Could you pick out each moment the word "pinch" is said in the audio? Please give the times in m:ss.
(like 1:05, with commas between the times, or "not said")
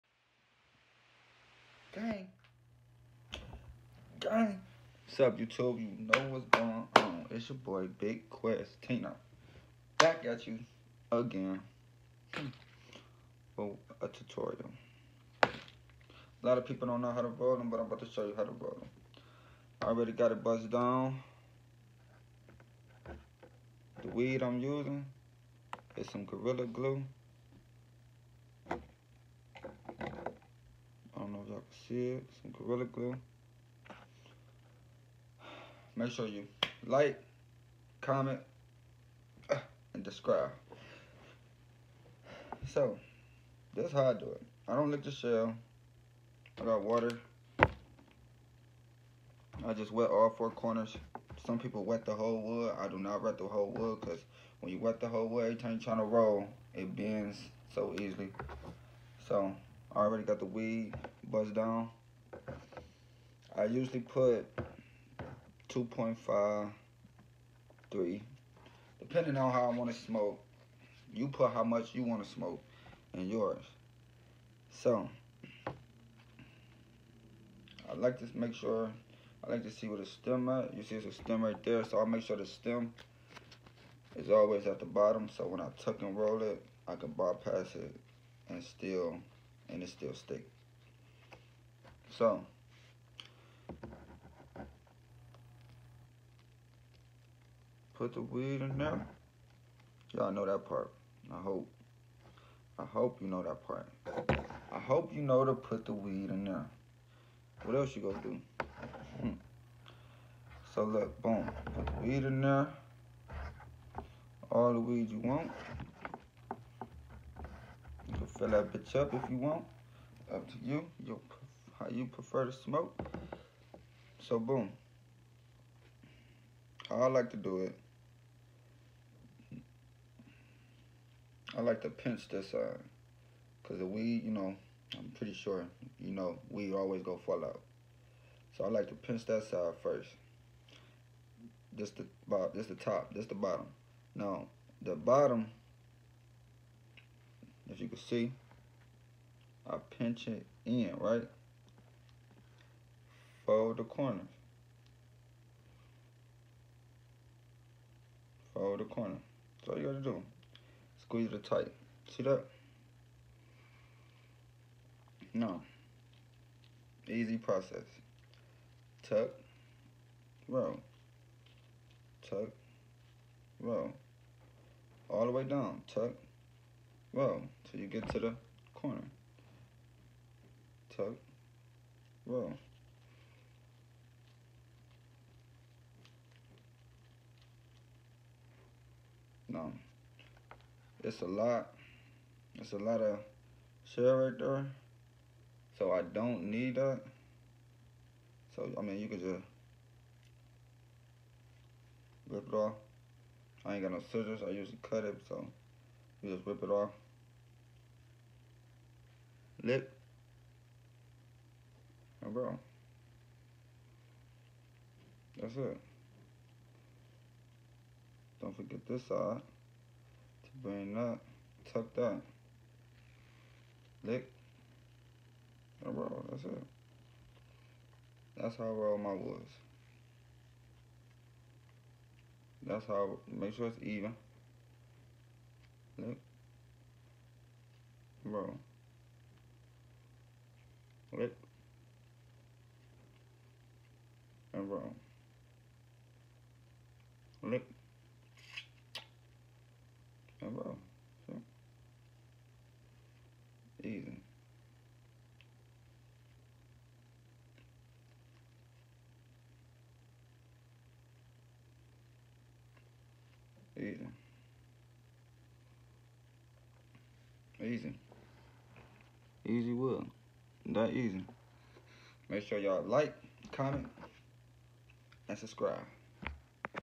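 2:11, 2:18, 2:29.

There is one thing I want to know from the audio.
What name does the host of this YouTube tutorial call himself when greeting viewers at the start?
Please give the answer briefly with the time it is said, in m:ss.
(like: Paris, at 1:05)
Big Quezz Tino, at 0:07.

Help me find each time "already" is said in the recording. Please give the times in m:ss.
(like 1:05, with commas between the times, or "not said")
0:19, 0:59.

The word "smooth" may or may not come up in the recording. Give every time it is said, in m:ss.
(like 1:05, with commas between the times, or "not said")
not said.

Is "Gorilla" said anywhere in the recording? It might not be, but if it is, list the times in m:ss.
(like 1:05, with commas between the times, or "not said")
0:26, 0:32.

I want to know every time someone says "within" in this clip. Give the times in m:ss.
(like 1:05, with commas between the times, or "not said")
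not said.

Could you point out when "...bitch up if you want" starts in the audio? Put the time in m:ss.
1:58.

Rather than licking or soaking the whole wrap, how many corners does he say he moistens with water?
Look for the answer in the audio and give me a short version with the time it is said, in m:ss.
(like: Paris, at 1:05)
4, at 0:50.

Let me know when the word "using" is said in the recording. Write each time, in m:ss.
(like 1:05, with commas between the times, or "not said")
0:24.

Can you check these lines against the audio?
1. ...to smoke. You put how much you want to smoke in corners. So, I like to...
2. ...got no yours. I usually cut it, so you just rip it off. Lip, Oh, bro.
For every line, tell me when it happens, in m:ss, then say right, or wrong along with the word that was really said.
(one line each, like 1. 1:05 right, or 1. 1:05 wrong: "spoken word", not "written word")
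1. 1:09 wrong: "yours", not "corners"
2. 3:23 wrong: "scissors", not "yours".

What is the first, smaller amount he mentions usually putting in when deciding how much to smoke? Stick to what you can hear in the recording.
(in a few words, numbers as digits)
2.5.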